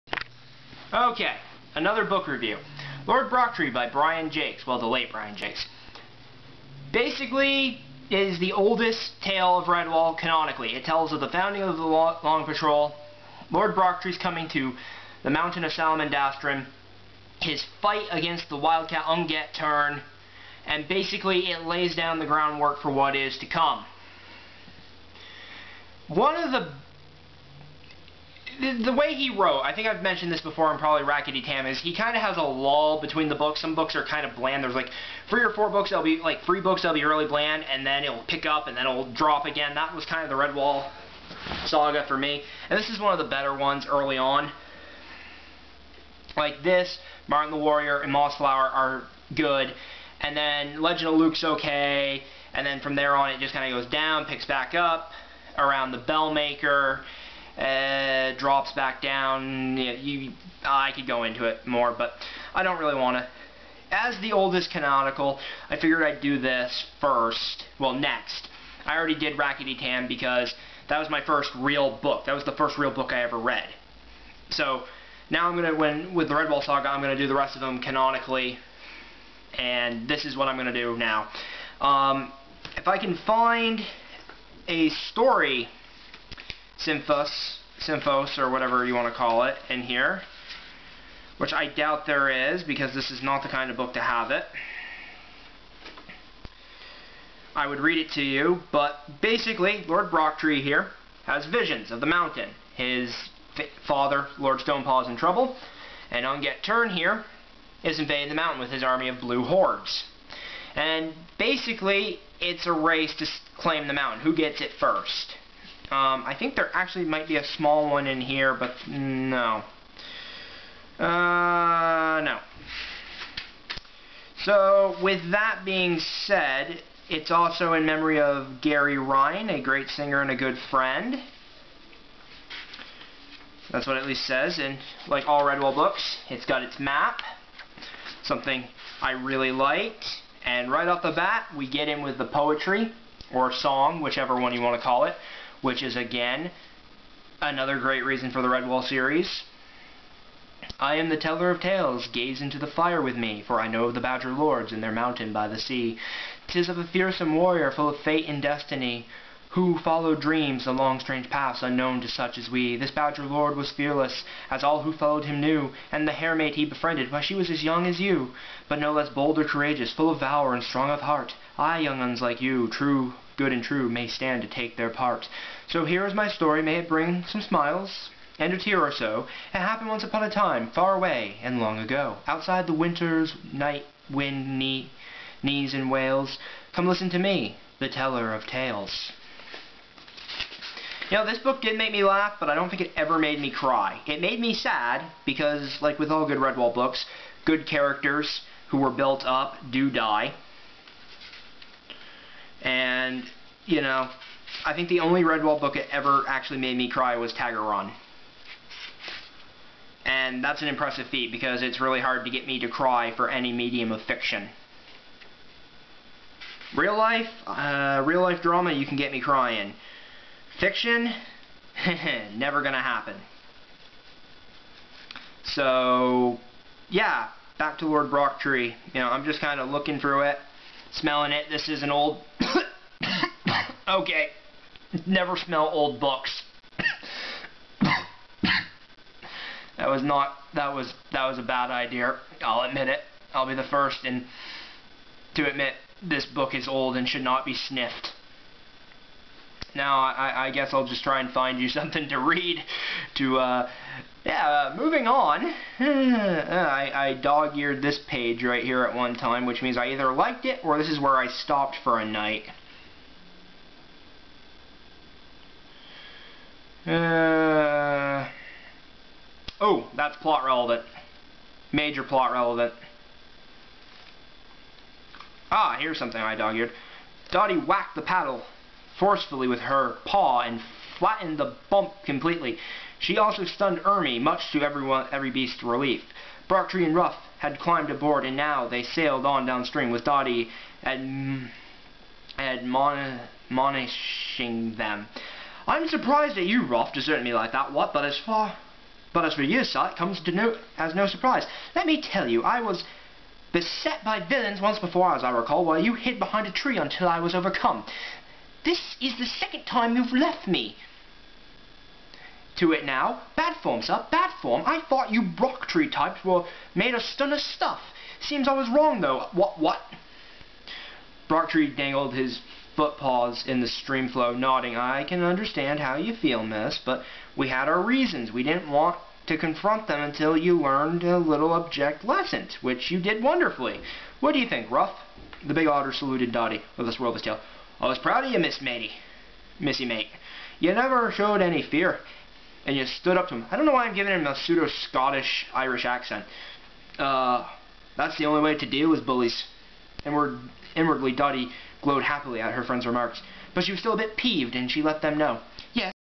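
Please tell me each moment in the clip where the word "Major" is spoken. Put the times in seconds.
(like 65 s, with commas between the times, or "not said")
271 s.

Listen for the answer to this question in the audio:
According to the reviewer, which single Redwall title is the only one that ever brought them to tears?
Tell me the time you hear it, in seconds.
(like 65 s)
207 s.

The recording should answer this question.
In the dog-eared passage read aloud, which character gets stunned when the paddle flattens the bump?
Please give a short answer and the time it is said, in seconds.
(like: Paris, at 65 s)
Ermi, at 283 s.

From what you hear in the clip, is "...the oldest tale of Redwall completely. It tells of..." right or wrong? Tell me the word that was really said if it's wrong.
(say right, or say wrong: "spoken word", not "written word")
wrong: "canonically", not "completely".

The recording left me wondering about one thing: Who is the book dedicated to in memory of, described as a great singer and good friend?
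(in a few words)
Gary Ryan.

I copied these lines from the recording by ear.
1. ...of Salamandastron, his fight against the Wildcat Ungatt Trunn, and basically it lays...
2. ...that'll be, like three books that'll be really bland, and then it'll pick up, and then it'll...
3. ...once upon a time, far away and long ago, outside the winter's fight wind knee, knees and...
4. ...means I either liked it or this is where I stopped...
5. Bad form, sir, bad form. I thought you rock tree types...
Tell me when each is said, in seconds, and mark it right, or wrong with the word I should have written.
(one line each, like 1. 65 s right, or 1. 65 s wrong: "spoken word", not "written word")
1. 15 s right
2. 35 s right
3. 179 s wrong: "night", not "fight"
4. 259 s right
5. 313 s right.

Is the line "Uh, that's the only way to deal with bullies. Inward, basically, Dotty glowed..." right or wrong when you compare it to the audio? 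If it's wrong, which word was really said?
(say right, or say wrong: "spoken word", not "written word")
wrong: "inwardly", not "basically".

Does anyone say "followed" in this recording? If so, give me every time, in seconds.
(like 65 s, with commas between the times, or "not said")
159 s, 164 s.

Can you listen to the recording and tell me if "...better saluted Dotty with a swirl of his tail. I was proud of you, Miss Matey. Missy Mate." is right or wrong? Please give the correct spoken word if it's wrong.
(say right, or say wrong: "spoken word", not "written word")
wrong: "otter", not "better".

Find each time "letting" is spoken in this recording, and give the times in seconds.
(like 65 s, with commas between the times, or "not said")
not said.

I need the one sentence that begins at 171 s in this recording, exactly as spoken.
Ay, young uns like you, true good and true may stand to take their part.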